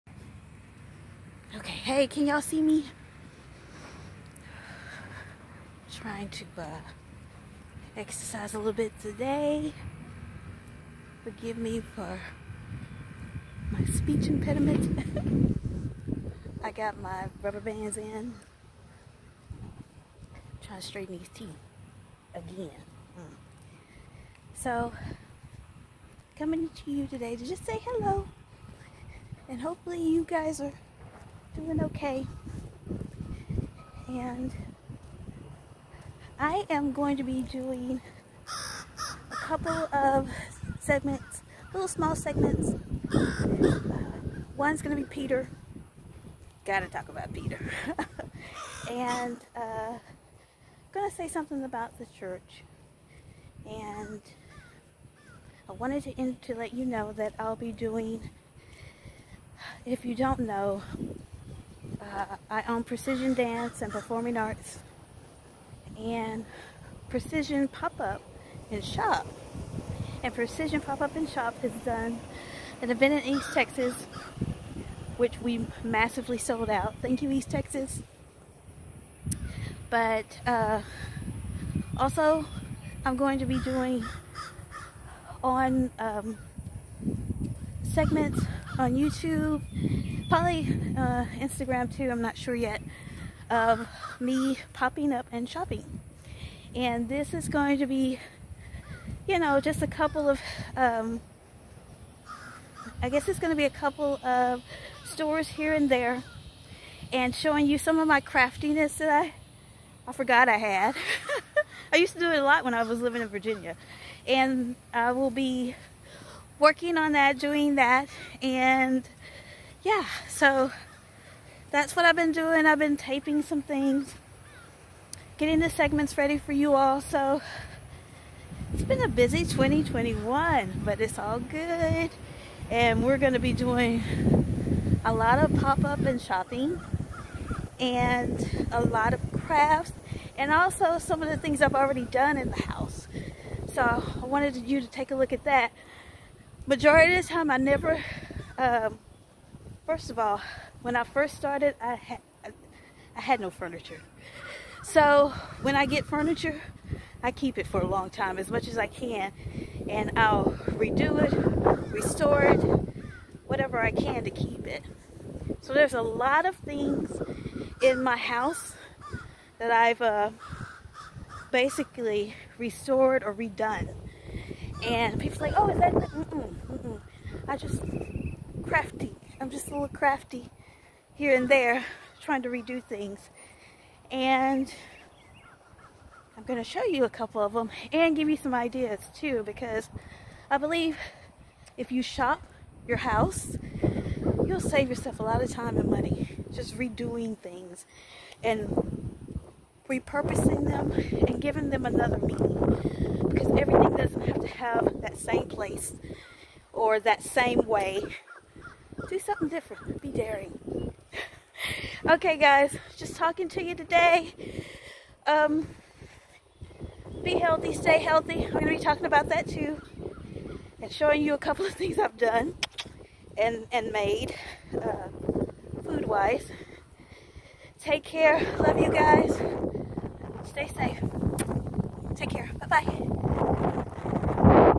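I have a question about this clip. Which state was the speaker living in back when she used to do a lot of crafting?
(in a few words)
Virginia.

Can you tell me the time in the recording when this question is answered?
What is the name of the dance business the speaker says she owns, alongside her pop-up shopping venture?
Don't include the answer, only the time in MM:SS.
01:02.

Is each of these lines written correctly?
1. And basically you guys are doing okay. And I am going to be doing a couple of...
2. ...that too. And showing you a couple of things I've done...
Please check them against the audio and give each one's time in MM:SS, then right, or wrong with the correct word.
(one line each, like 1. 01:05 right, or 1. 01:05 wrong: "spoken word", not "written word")
1. 00:29 wrong: "hopefully", not "basically"
2. 03:39 right.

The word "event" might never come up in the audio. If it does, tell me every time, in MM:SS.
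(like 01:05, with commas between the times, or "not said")
01:12.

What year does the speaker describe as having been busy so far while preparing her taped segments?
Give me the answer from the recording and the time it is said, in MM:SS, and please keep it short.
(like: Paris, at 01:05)
2021, at 02:09.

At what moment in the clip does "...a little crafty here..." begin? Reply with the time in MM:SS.
02:59.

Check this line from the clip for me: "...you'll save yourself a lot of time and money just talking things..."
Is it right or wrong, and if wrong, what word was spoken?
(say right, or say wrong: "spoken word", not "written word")
wrong: "redoing", not "talking".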